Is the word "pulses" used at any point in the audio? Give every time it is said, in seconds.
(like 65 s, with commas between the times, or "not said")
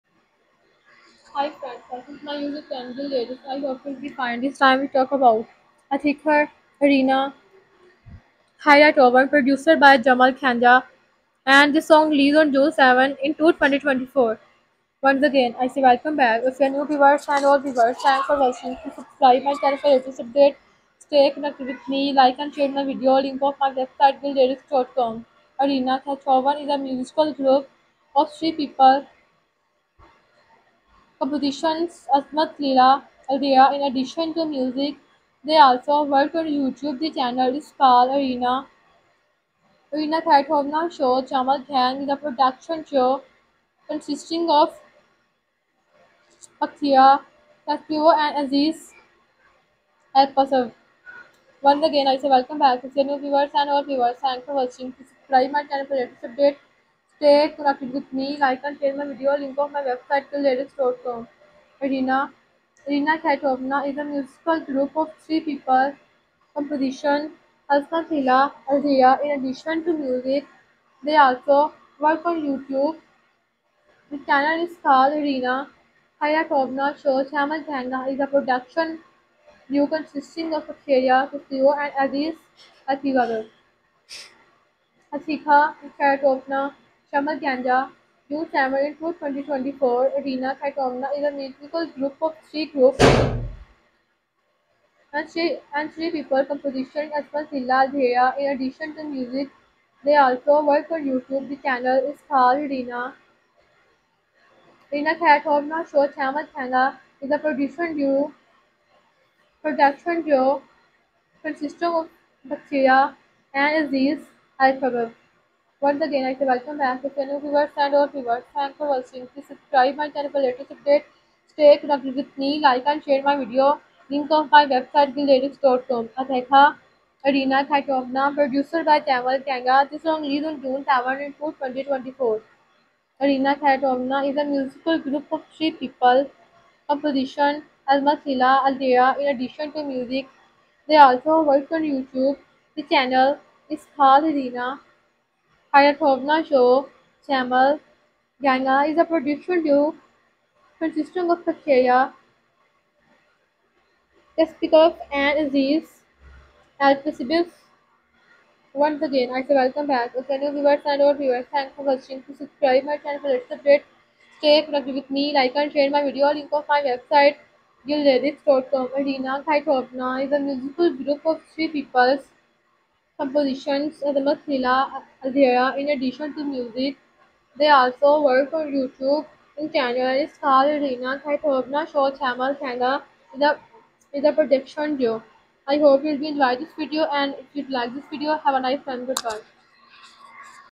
2 s.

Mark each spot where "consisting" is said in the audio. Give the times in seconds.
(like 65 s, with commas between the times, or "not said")
43 s, 79 s, 111 s, 150 s.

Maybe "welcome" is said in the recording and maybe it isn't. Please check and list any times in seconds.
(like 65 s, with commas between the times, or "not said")
15 s, 52 s, 116 s, 159 s.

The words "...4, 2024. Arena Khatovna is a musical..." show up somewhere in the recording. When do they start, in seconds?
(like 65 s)
131 s.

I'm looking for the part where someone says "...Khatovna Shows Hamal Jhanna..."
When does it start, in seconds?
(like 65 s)
76 s.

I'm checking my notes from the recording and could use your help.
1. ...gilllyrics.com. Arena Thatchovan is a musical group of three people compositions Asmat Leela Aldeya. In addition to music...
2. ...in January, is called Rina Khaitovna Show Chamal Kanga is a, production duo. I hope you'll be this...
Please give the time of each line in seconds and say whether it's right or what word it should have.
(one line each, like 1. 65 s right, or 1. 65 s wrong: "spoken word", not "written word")
1. 24 s right
2. 179 s right.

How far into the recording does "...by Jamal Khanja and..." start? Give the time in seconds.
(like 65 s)
9 s.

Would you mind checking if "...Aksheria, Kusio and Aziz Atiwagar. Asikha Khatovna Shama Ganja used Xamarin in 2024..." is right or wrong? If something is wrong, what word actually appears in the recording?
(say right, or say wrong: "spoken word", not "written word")
right.